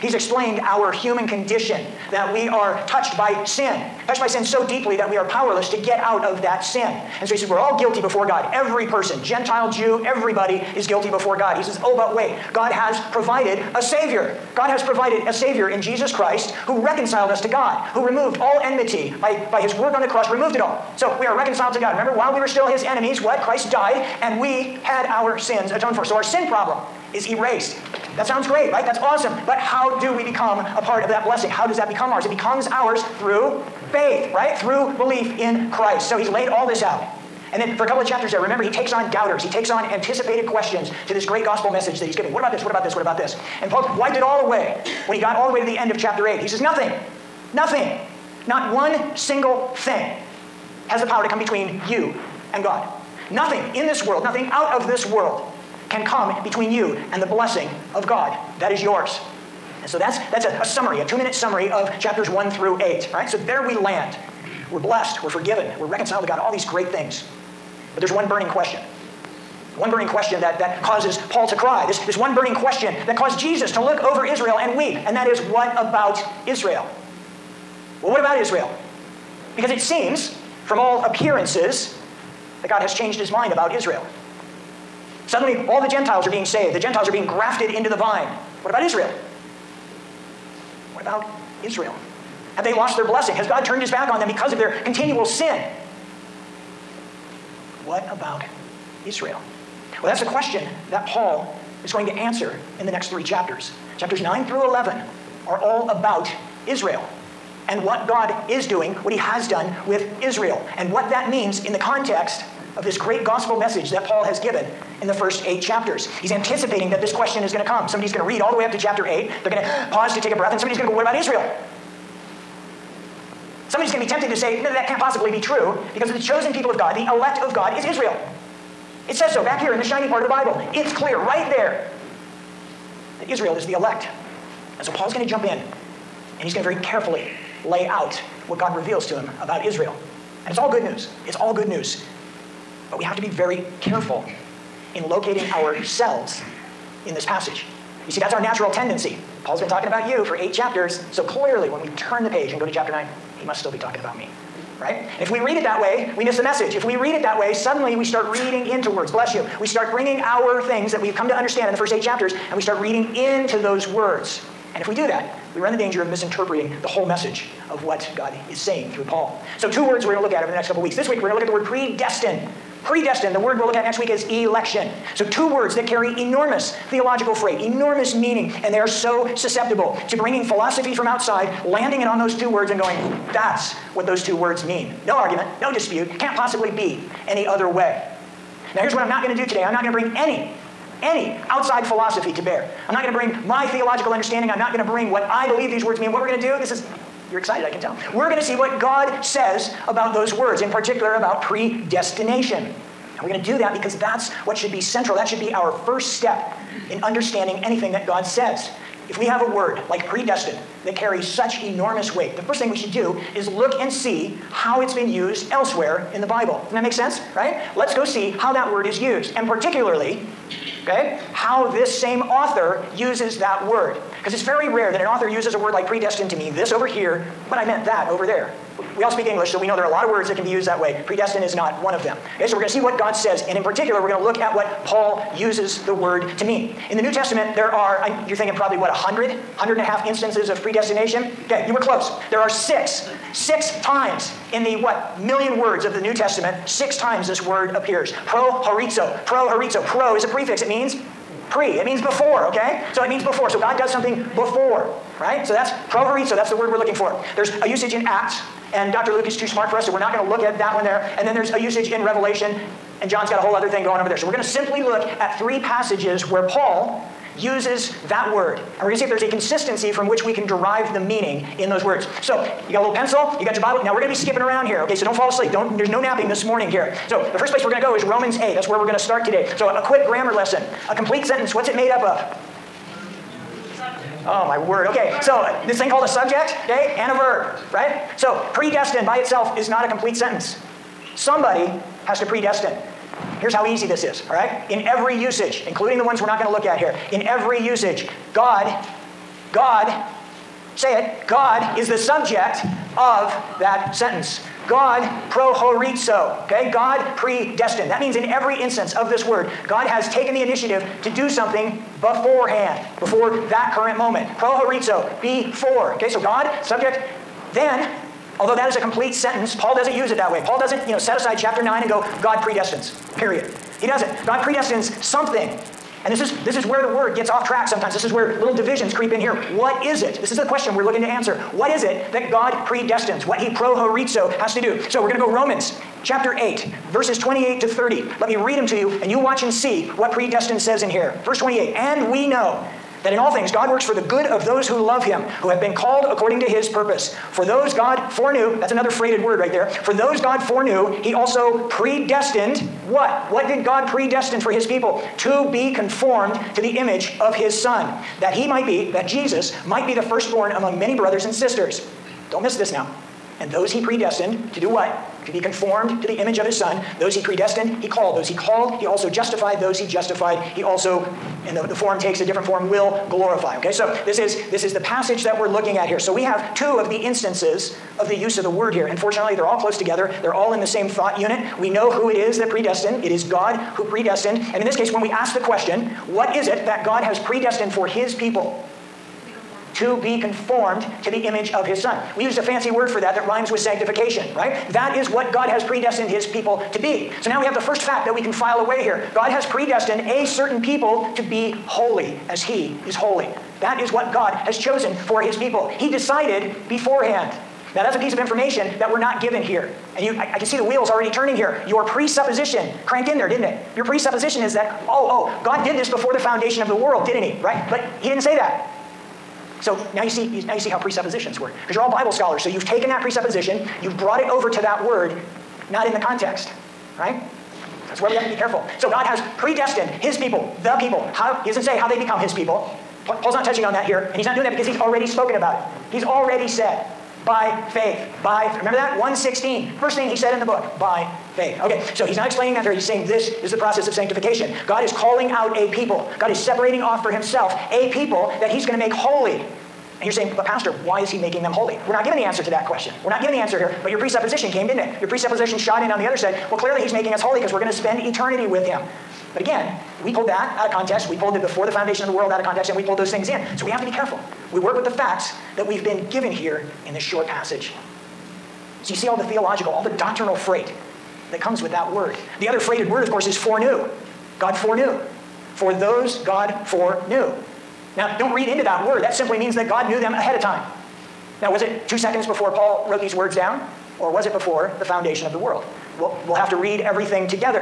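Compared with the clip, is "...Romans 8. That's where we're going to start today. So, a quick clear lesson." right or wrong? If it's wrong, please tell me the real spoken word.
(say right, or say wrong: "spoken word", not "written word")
wrong: "grammar", not "clear".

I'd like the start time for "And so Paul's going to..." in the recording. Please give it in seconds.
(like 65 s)
134 s.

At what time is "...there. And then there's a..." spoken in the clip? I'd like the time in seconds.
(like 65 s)
260 s.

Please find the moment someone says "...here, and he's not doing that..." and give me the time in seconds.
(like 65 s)
433 s.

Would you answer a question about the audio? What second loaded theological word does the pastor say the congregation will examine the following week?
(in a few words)
Election.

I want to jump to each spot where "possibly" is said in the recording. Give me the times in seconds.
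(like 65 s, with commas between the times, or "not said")
124 s, 186 s.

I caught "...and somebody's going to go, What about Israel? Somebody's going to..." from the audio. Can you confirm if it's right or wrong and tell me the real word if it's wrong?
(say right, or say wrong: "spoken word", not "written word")
right.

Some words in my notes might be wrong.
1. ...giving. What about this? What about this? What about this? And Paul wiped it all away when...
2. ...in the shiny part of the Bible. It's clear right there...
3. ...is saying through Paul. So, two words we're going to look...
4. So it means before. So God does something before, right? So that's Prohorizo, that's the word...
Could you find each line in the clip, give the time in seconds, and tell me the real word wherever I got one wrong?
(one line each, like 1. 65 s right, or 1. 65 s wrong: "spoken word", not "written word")
1. 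42 s right
2. 129 s right
3. 168 s right
4. 252 s right.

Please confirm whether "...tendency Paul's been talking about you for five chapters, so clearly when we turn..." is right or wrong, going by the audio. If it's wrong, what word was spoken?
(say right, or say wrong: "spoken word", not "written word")
wrong: "eight", not "five".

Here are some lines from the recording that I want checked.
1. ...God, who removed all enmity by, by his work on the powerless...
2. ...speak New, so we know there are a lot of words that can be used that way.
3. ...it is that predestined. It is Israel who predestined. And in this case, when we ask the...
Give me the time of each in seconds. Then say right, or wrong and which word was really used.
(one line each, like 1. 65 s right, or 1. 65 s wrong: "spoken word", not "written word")
1. 17 s wrong: "cross", not "powerless"
2. 229 s wrong: "English", not "New"
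3. 382 s wrong: "God", not "Israel".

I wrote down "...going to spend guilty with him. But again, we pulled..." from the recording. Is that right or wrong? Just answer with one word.
wrong.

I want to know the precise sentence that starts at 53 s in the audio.
Nothing in this world, nothing out of this world can come between you and the blessing of God that is yours.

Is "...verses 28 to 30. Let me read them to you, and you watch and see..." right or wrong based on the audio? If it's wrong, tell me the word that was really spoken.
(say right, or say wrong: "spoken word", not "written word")
right.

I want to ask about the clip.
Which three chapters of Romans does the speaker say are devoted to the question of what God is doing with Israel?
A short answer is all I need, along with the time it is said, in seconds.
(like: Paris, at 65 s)
Chapters 9 through 11, at 103 s.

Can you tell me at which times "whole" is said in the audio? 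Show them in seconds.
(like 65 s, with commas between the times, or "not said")
166 s, 263 s.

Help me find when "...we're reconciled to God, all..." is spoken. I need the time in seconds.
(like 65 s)
65 s.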